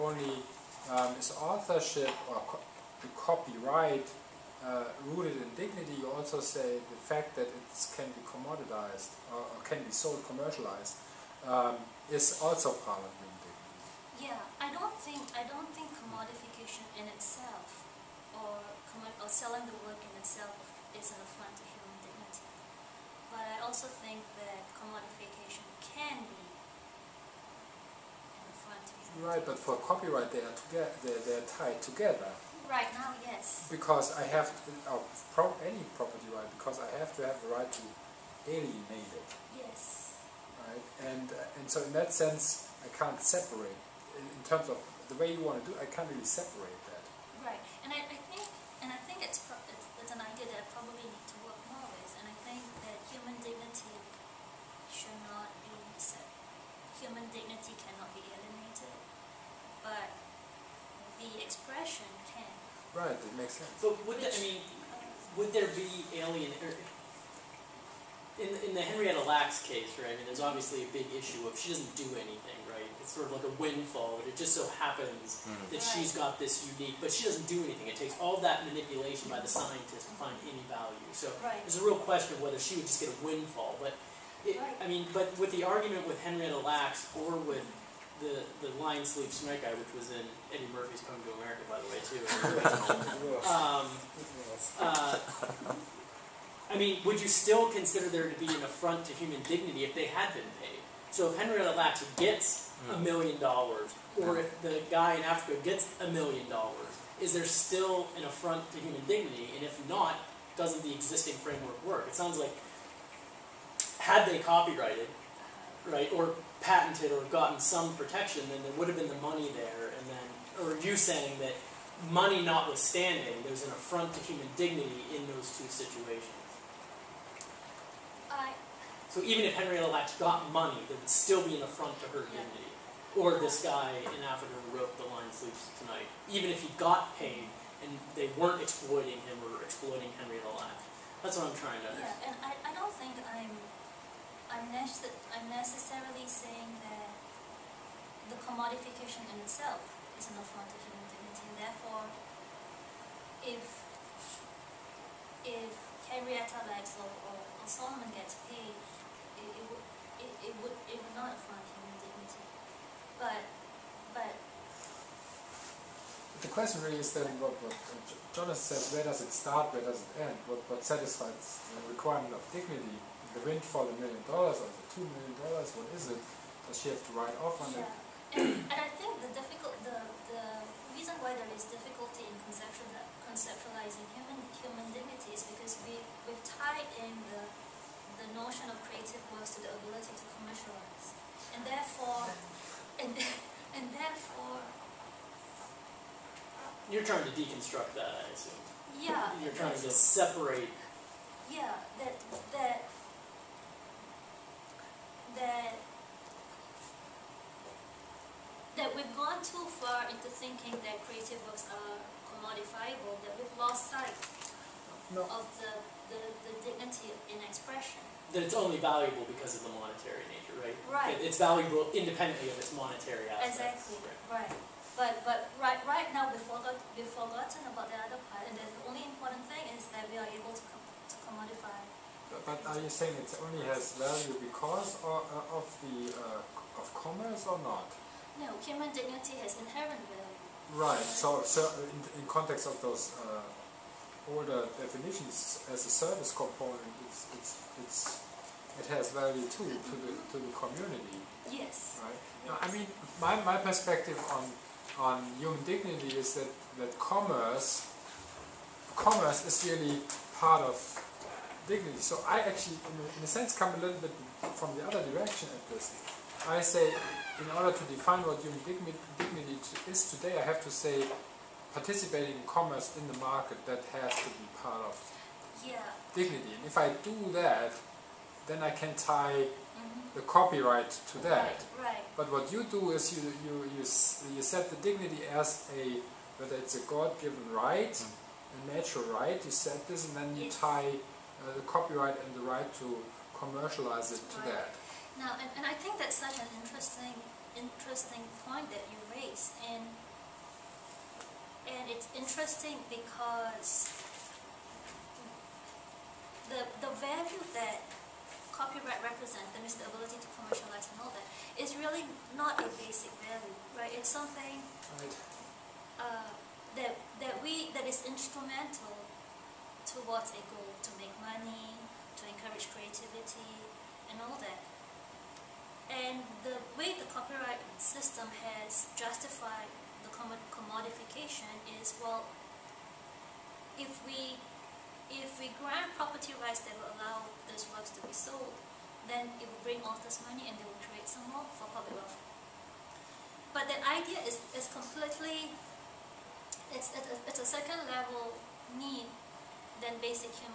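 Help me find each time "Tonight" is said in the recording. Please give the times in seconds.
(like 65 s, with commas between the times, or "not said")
89 s, 135 s.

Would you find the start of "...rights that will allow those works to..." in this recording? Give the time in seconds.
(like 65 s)
336 s.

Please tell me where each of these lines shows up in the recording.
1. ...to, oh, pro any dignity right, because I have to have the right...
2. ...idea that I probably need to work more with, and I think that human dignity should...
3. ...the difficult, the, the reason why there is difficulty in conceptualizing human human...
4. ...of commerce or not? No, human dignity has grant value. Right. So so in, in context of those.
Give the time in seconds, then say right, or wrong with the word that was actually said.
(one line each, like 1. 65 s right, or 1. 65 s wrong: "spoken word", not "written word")
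1. 34 s wrong: "property", not "dignity"
2. 50 s right
3. 179 s right
4. 236 s wrong: "inherent", not "grant".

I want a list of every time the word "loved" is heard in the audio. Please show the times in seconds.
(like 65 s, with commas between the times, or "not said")
not said.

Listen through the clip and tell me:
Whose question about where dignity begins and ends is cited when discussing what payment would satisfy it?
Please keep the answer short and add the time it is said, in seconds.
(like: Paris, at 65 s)
Jonas, at 168 s.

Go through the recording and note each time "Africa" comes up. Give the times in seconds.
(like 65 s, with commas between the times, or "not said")
105 s, 134 s.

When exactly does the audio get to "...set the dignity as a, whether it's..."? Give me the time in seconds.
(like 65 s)
284 s.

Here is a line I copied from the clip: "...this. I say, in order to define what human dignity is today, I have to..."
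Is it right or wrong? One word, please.
right.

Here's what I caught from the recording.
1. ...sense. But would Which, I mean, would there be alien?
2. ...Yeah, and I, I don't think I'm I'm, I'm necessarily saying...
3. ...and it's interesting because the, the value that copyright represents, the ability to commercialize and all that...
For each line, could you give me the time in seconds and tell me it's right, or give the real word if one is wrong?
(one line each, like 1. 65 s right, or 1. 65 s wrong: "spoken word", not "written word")
1. 63 s right
2. 141 s right
3. 301 s right.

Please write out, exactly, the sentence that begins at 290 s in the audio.
tie uh, the copyright and the right to commercialize it to right.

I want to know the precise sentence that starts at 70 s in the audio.
I mean, there's obviously a big issue of she doesn't do anything it's sort of like a windfall.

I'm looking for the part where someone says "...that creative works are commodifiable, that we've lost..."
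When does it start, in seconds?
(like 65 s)
210 s.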